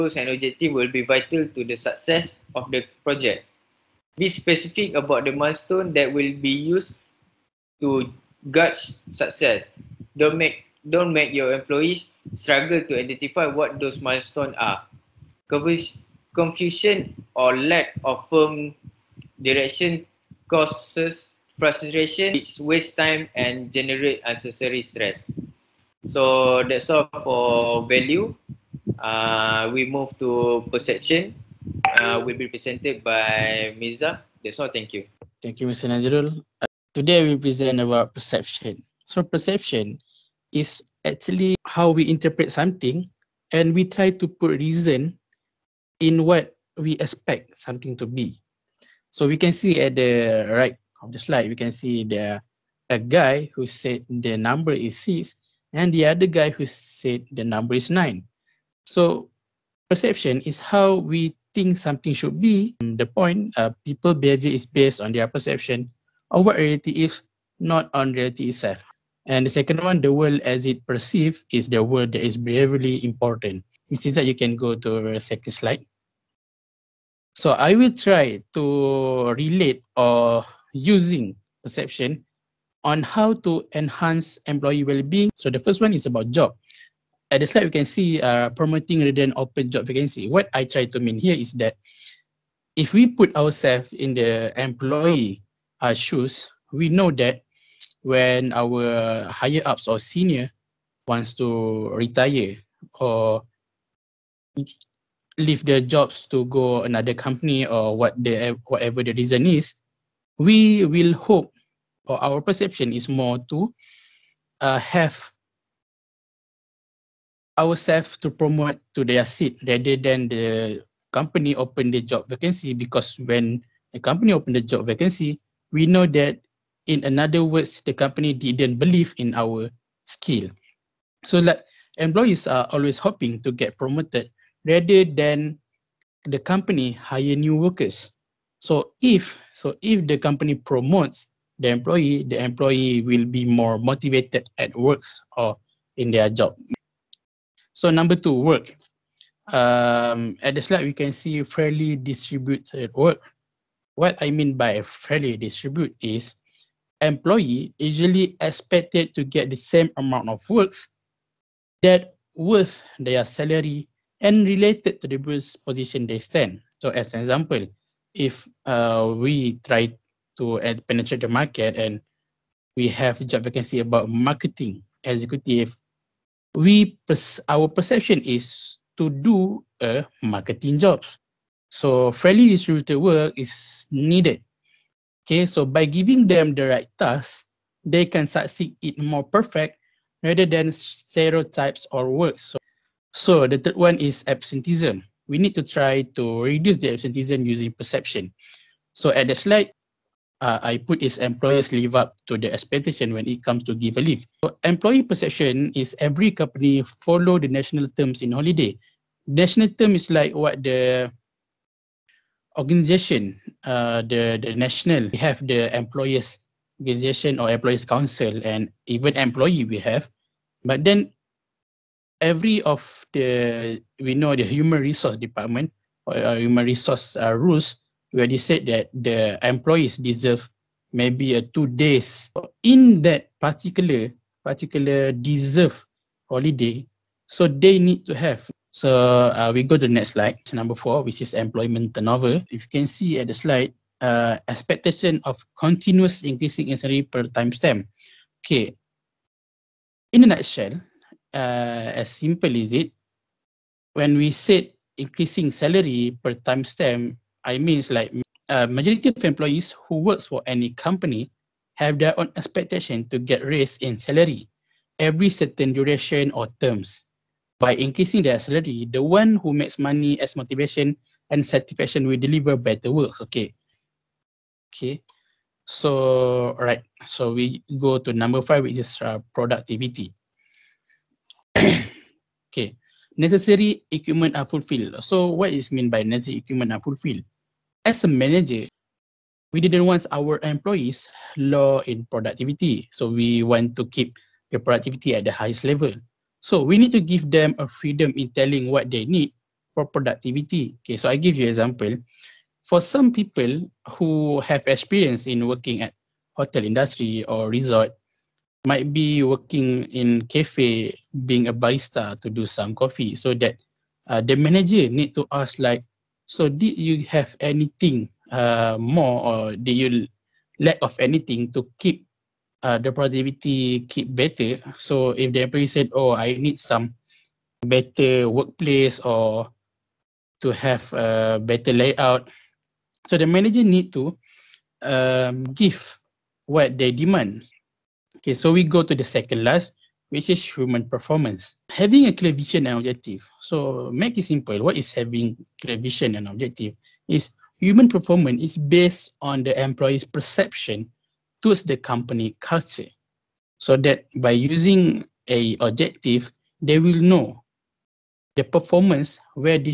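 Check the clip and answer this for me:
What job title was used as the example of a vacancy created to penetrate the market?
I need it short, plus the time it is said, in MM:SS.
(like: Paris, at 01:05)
Marketing executive, at 02:54.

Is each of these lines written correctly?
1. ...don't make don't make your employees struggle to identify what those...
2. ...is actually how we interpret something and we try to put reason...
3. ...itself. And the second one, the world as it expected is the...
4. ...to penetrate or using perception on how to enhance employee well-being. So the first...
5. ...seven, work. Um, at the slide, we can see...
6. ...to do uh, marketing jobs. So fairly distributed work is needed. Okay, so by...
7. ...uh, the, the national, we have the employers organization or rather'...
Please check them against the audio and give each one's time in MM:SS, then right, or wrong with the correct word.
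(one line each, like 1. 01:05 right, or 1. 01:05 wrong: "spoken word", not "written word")
1. 00:10 right
2. 00:40 right
3. 01:08 wrong: "perceived", not "expected"
4. 01:18 wrong: "relate", not "penetrate"
5. 02:28 wrong: "two", not "seven"
6. 02:58 right
7. 03:33 wrong: "employers", not "rather".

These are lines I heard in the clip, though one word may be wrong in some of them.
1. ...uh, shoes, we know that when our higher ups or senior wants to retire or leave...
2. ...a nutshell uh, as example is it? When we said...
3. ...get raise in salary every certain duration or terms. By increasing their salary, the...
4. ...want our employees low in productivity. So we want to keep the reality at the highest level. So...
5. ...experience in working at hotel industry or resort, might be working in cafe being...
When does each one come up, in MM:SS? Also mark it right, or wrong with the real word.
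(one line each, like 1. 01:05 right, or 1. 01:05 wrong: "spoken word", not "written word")
1. 01:35 right
2. 04:10 wrong: "simple", not "example"
3. 04:23 right
4. 04:49 wrong: "productivity", not "reality"
5. 05:04 right.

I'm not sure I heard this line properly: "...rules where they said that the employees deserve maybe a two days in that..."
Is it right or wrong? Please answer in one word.
right.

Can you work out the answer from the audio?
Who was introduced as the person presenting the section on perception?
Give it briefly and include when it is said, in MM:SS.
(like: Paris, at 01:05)
Mirza, at 00:33.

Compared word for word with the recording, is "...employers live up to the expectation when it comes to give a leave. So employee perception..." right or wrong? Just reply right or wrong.
right.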